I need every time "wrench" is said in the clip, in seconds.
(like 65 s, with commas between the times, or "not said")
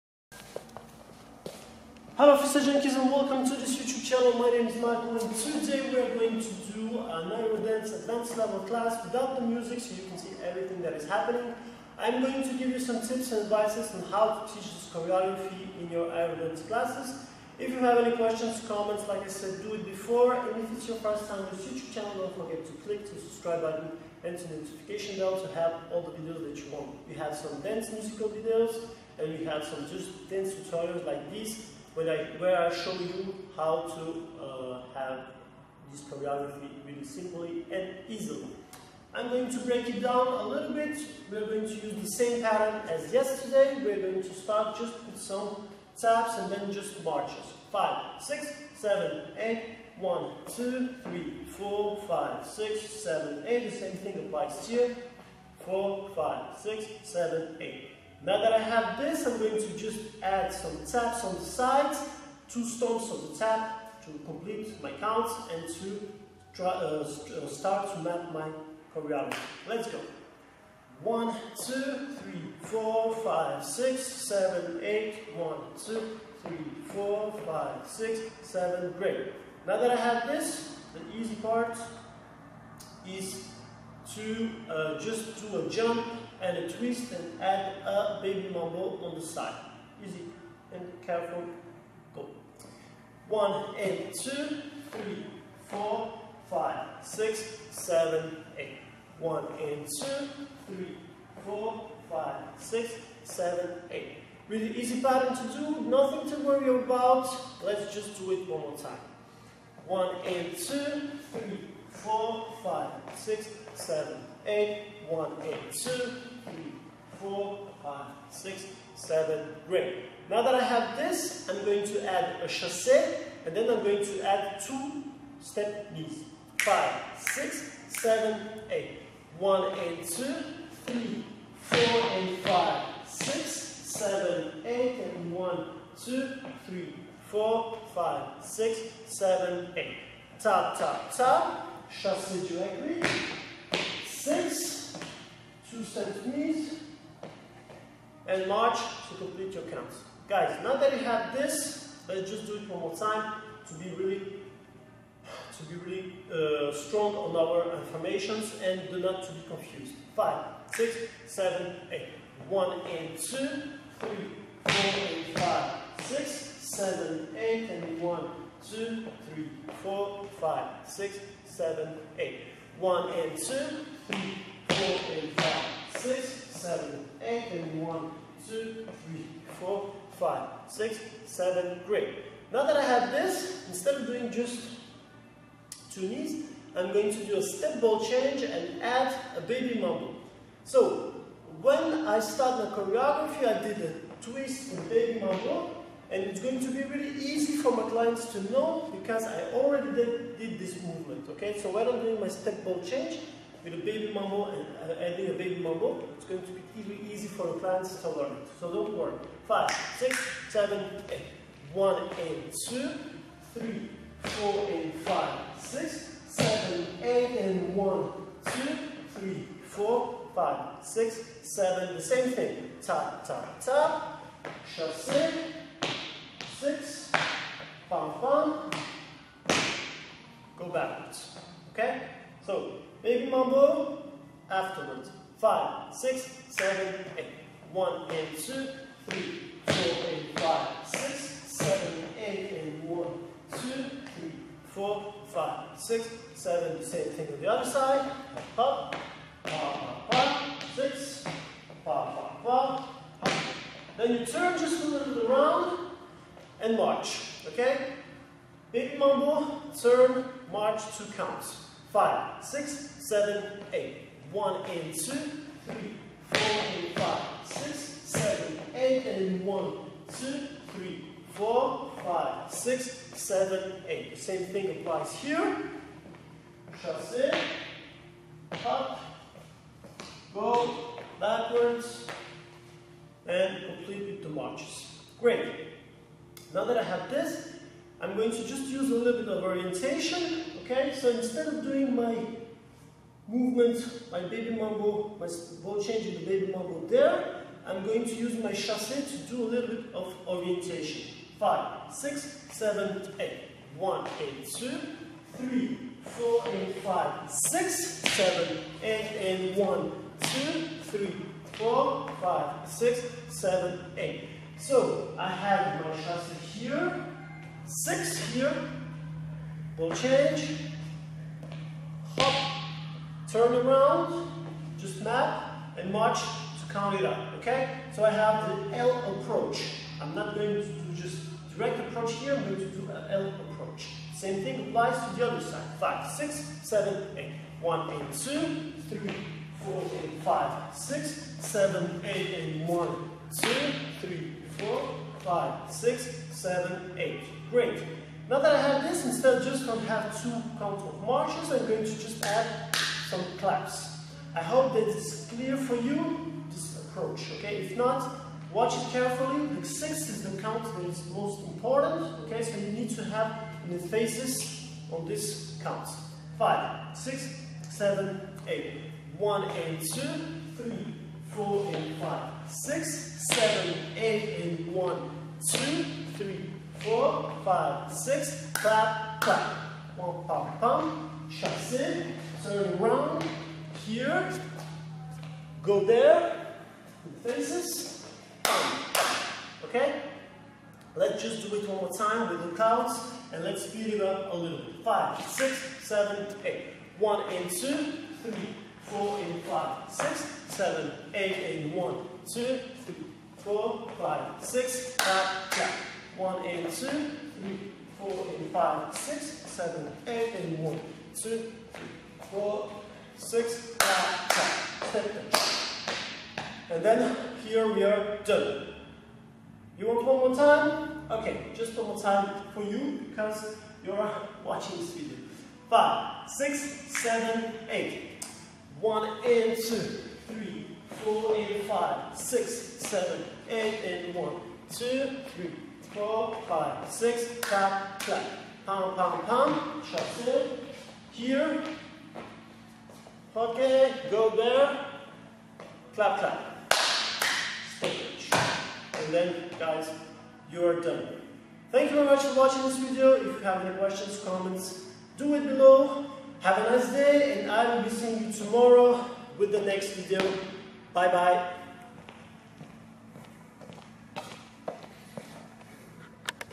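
not said.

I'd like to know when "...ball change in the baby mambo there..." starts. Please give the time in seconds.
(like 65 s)
295 s.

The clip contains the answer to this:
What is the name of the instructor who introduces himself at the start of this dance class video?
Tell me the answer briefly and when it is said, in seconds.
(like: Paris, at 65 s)
Marko, at 4 s.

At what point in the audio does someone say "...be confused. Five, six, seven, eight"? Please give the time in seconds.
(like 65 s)
159 s.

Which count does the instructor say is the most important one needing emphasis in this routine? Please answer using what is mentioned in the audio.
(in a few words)
6.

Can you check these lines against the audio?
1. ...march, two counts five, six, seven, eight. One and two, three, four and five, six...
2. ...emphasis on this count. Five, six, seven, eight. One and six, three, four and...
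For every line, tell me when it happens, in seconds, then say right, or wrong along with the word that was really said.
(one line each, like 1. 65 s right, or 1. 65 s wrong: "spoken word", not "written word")
1. 260 s right
2. 363 s wrong: "two", not "six".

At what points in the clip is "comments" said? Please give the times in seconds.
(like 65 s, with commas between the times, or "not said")
18 s, 454 s.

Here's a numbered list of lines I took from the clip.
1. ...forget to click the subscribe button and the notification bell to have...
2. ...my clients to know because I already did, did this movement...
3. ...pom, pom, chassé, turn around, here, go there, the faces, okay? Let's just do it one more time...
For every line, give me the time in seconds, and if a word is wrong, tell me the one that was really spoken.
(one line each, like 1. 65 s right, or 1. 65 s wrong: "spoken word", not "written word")
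1. 22 s right
2. 197 s right
3. 380 s right.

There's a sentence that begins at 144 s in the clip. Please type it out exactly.
Six, two and march to complete your counts.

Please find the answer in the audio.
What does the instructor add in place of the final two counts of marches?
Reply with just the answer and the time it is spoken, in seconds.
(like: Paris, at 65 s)
claps, at 351 s.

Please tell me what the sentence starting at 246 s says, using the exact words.
Same thing on the other side.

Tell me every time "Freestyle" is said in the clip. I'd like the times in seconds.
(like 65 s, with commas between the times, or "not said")
2 s.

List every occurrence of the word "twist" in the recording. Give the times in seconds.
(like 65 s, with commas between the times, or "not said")
86 s, 194 s.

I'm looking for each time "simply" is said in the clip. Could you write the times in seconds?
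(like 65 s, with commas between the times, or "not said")
37 s.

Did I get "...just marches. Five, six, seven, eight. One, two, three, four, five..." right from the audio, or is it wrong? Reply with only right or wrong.
right.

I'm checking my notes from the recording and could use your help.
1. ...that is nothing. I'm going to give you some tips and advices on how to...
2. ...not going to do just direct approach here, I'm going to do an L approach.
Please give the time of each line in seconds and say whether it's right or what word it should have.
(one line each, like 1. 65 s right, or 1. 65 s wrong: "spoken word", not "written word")
1. 10 s wrong: "happening", not "nothing"
2. 330 s right.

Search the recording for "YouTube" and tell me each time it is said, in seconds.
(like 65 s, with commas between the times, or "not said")
3 s, 21 s.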